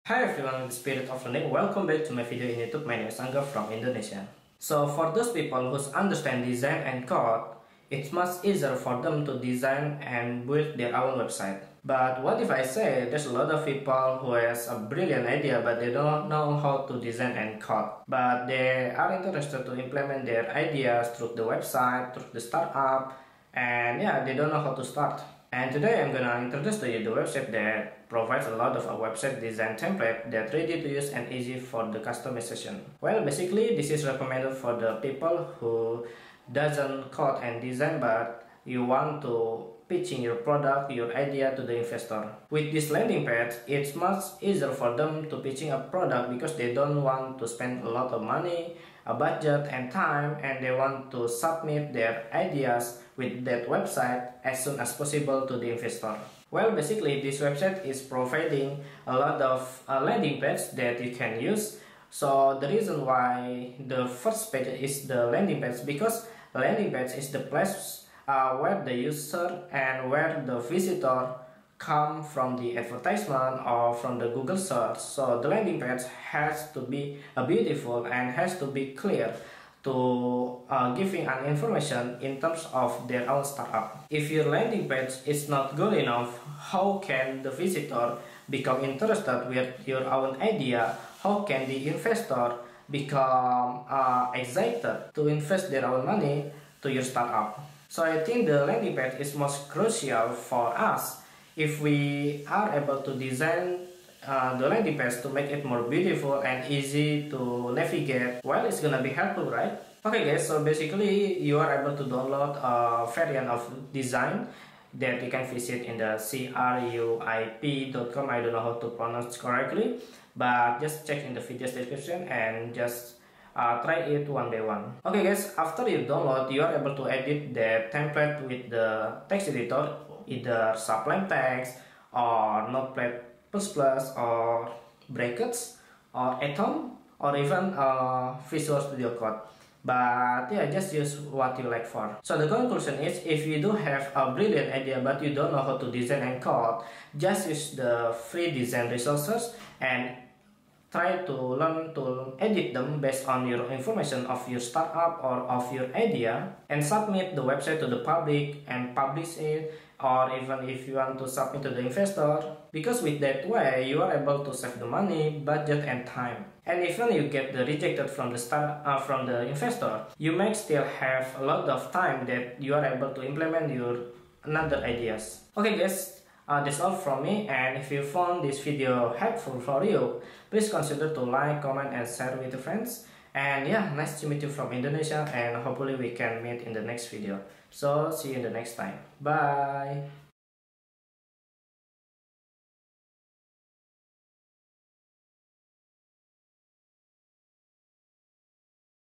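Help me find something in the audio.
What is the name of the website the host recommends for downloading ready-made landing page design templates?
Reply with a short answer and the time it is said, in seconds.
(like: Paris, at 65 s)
cruip.com, at 116 s.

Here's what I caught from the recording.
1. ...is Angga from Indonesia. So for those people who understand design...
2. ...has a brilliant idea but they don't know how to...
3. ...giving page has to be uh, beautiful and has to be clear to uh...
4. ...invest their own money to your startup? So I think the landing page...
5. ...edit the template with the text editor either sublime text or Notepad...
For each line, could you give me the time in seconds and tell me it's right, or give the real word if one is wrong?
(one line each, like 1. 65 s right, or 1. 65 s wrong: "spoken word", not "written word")
1. 3 s right
2. 14 s right
3. 75 s wrong: "landing", not "giving"
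4. 95 s right
5. 127 s right.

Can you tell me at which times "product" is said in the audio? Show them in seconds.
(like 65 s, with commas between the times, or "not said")
40 s, 45 s.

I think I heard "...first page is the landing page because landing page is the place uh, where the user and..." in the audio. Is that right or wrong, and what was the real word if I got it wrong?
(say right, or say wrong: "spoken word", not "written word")
right.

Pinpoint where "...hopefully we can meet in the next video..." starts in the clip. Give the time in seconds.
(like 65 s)
185 s.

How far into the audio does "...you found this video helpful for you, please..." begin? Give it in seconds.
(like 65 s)
177 s.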